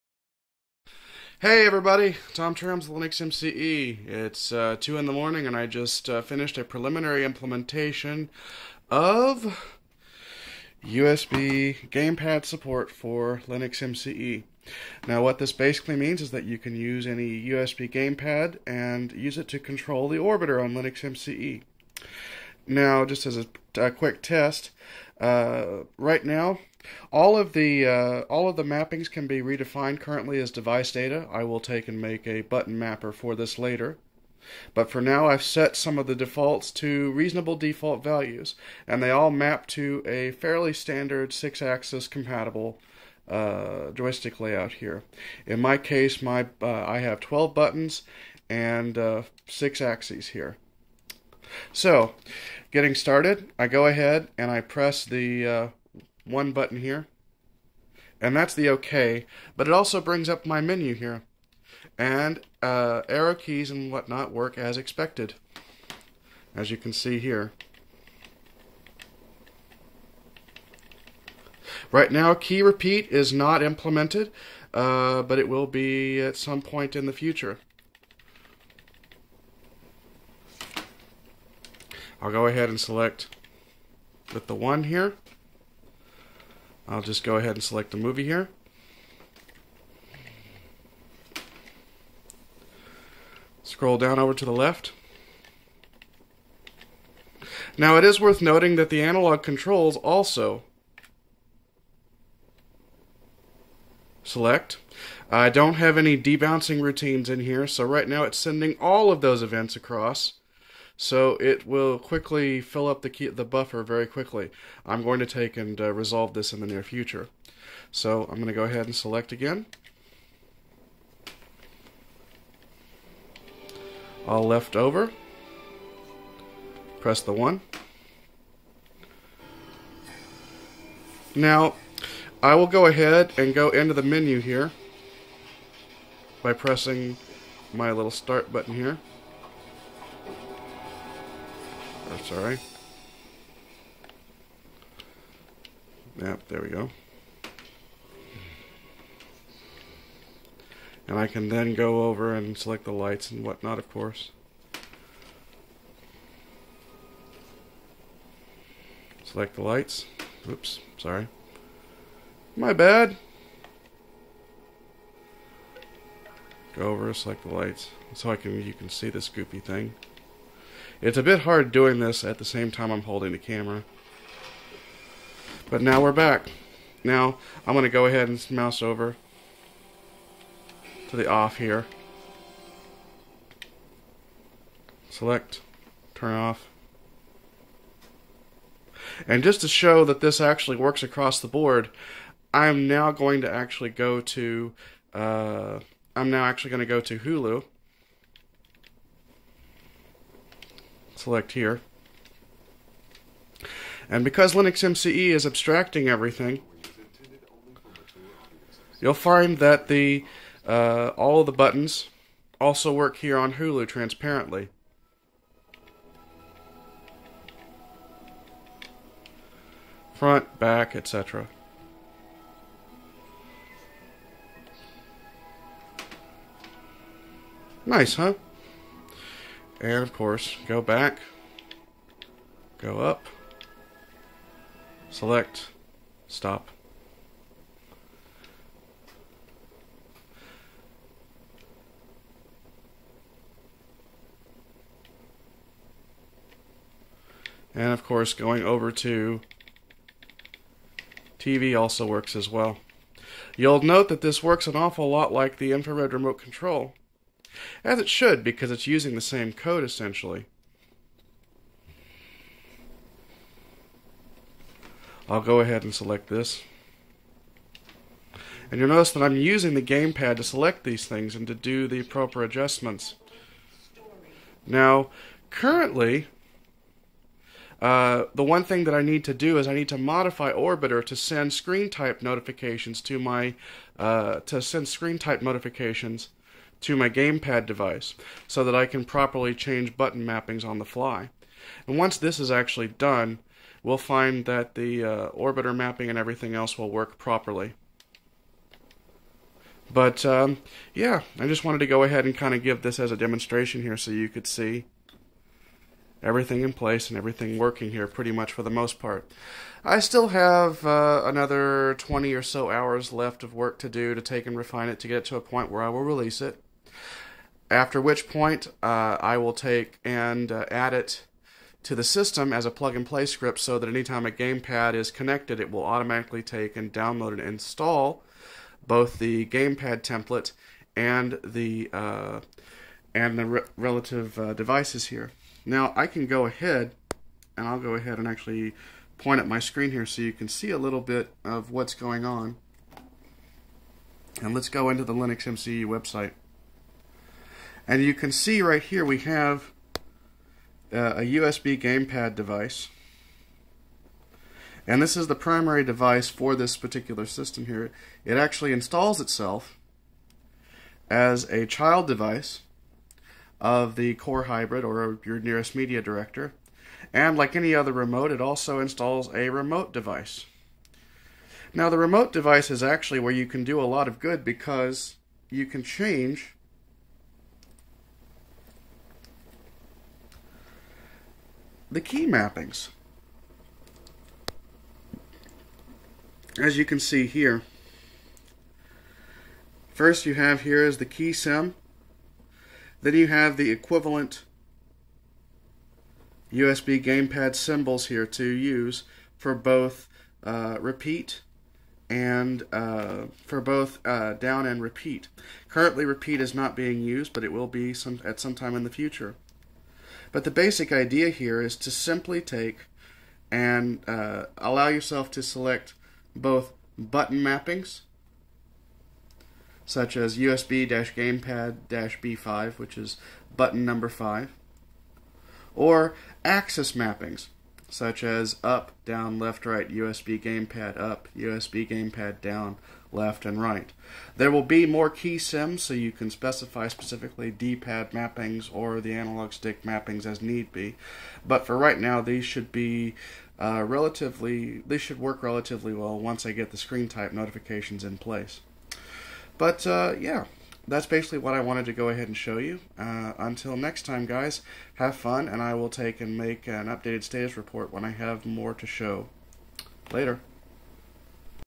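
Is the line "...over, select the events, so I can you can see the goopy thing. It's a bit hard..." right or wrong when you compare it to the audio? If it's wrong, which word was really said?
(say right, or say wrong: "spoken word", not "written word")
wrong: "lights", not "events".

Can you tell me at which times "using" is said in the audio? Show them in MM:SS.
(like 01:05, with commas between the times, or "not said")
04:18, 04:29.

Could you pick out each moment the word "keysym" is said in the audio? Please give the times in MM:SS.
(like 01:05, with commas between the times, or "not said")
06:31, 07:15.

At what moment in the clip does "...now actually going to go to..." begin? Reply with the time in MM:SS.
03:16.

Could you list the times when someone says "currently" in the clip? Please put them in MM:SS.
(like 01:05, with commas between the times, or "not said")
00:29, 04:35, 06:45.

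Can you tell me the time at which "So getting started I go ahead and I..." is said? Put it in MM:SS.
00:51.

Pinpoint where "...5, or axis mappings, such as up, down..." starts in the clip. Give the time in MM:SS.
07:04.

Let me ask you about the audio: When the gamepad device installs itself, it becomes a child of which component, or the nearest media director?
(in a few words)
Core Hybrid.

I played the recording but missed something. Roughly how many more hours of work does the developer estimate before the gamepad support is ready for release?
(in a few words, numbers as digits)
20.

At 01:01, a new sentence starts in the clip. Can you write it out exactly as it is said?
And uh, arrow keys and whatnot work as expected, as you can see here.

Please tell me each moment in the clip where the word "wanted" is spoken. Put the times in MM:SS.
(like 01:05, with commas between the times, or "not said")
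05:01, 07:31.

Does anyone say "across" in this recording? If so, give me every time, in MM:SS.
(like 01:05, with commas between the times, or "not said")
01:49, 03:11.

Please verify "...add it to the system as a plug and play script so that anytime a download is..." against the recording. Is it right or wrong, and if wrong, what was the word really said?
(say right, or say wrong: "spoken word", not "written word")
wrong: "gamepad", not "download".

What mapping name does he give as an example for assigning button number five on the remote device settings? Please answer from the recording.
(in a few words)
USB-gamepad-B5.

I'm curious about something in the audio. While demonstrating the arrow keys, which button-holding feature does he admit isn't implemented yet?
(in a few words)
Key repeat.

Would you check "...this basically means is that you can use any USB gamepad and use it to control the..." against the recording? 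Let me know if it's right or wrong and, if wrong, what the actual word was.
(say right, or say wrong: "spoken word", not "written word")
right.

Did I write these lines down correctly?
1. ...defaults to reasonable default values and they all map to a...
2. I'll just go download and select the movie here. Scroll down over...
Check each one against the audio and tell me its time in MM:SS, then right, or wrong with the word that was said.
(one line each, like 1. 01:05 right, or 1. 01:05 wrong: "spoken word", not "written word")
1. 00:36 right
2. 01:26 wrong: "ahead", not "download".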